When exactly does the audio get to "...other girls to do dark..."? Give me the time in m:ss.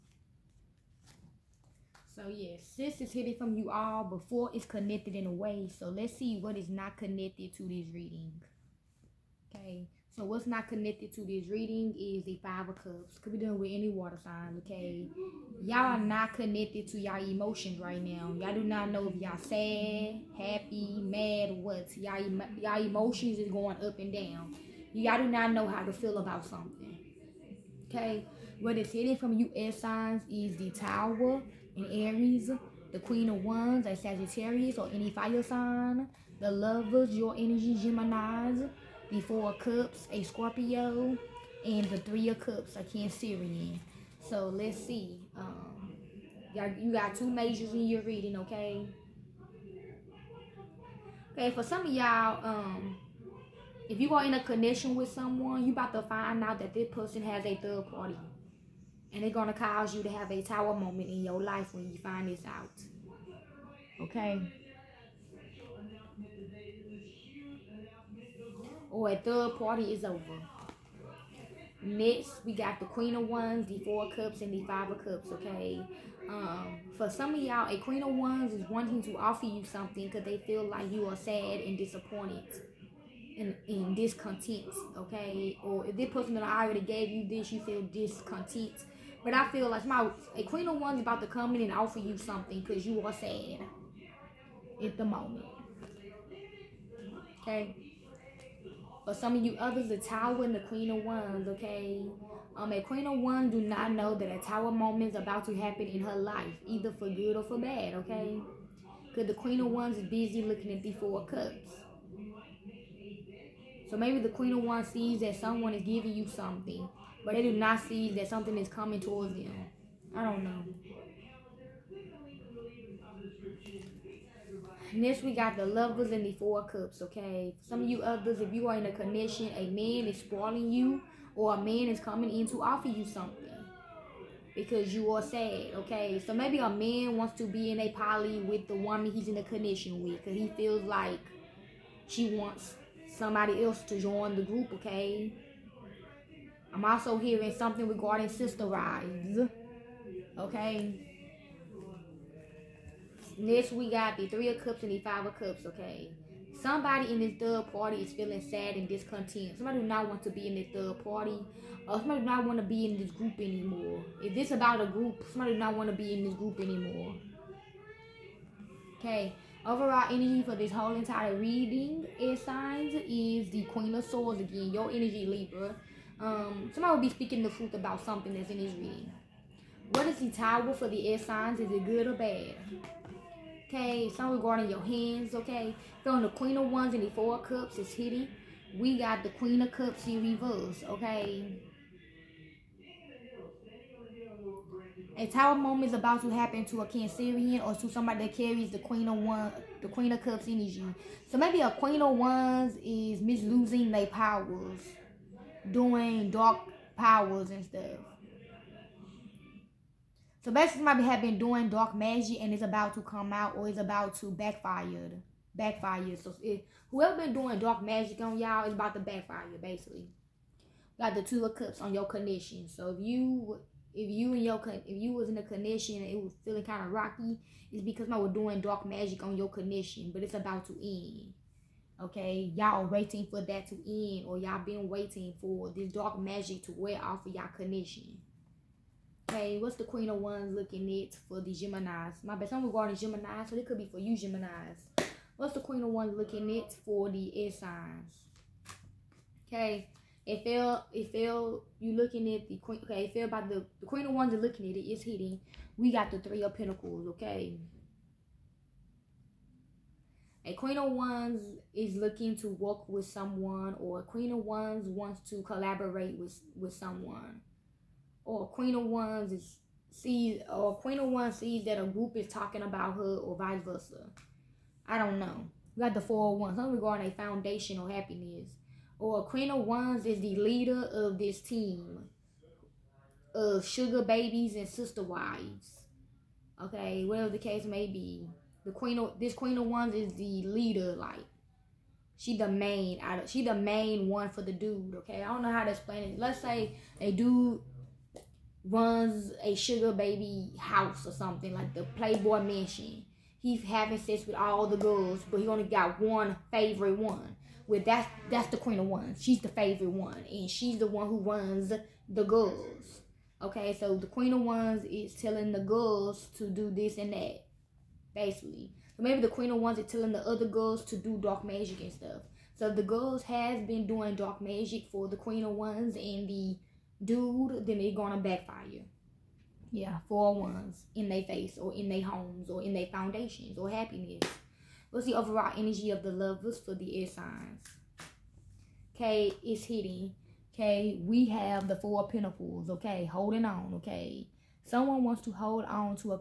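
5:20.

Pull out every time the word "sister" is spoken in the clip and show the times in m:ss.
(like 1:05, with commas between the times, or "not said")
2:28, 4:44.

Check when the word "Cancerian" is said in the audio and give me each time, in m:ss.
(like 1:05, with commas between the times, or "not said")
0:42, 3:16.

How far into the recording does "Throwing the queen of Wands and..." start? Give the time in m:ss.
3:06.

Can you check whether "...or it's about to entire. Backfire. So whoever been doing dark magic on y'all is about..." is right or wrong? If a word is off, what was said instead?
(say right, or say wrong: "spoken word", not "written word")
wrong: "backfire", not "entire".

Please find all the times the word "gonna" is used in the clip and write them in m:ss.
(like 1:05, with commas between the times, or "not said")
5:27.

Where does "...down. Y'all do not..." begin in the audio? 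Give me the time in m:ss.
0:24.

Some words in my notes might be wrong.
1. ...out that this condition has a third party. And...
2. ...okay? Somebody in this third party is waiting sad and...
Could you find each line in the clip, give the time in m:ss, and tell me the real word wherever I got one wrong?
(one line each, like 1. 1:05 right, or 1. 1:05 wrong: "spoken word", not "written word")
1. 0:56 wrong: "person", not "condition"
2. 2:35 wrong: "feeling", not "waiting".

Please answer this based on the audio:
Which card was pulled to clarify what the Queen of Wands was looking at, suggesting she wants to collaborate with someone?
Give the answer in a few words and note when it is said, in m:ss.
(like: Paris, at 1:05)
Three of Pentacles, at 4:16.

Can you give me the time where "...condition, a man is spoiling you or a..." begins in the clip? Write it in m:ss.
2:08.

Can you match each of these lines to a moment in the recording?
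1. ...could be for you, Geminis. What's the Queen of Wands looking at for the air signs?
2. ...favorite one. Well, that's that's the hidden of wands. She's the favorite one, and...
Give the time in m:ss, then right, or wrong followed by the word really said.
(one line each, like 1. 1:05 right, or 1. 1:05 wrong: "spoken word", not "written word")
1. 4:03 right
2. 5:06 wrong: "queen", not "hidden".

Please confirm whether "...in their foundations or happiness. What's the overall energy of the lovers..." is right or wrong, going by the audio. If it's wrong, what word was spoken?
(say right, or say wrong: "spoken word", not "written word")
right.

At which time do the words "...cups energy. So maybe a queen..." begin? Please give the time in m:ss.
3:20.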